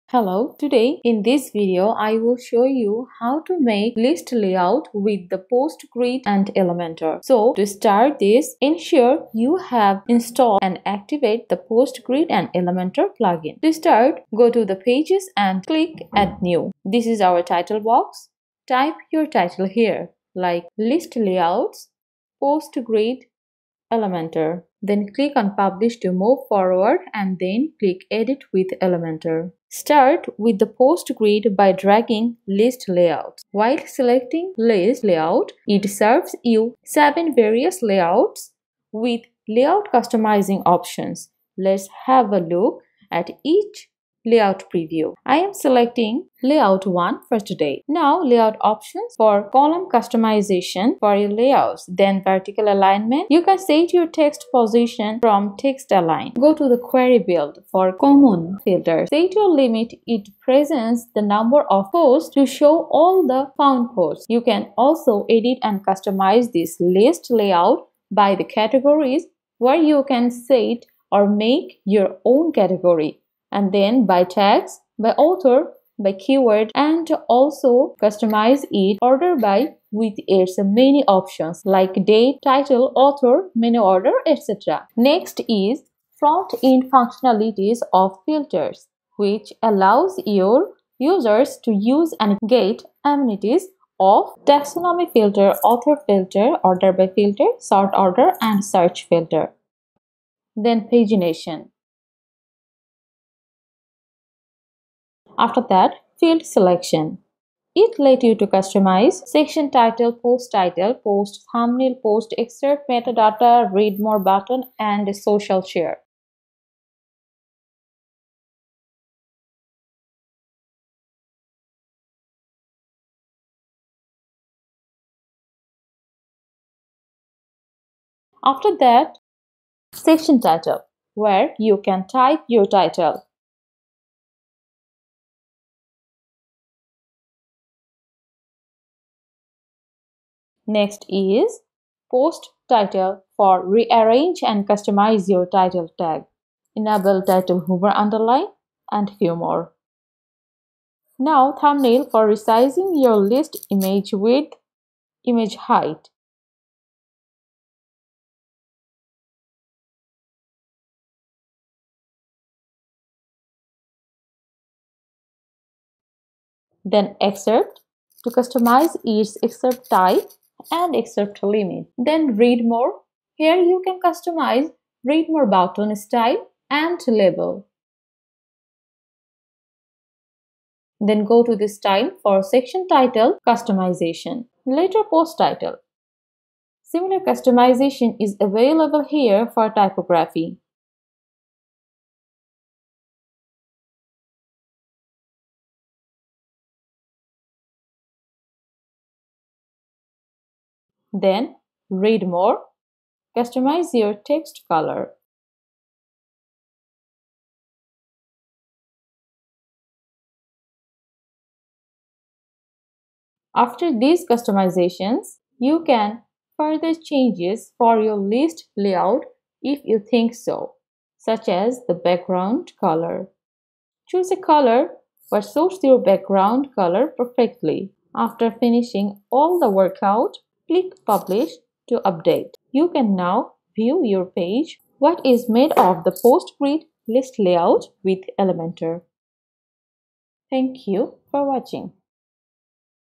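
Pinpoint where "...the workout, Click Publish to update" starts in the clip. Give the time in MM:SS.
03:49.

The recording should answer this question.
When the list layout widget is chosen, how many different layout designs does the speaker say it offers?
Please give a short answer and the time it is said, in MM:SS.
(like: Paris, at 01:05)
7, at 00:36.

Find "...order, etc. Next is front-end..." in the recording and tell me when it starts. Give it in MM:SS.
01:23.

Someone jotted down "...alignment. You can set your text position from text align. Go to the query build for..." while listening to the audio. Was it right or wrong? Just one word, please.
right.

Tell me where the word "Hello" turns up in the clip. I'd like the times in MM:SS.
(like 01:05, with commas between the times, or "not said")
00:00.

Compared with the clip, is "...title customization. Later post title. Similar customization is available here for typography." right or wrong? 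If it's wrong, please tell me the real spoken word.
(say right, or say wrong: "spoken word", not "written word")
right.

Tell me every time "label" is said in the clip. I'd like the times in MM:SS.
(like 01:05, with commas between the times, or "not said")
02:57.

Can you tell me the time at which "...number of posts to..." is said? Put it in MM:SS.
01:01.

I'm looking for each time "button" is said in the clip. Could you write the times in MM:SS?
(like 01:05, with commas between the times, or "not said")
01:54, 02:55.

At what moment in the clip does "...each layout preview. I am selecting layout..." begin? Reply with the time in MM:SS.
00:43.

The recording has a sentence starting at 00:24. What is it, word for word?
Then click on publish to move forward and then click edit with Elementor.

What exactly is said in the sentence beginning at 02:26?
Enable title hover underline and few more.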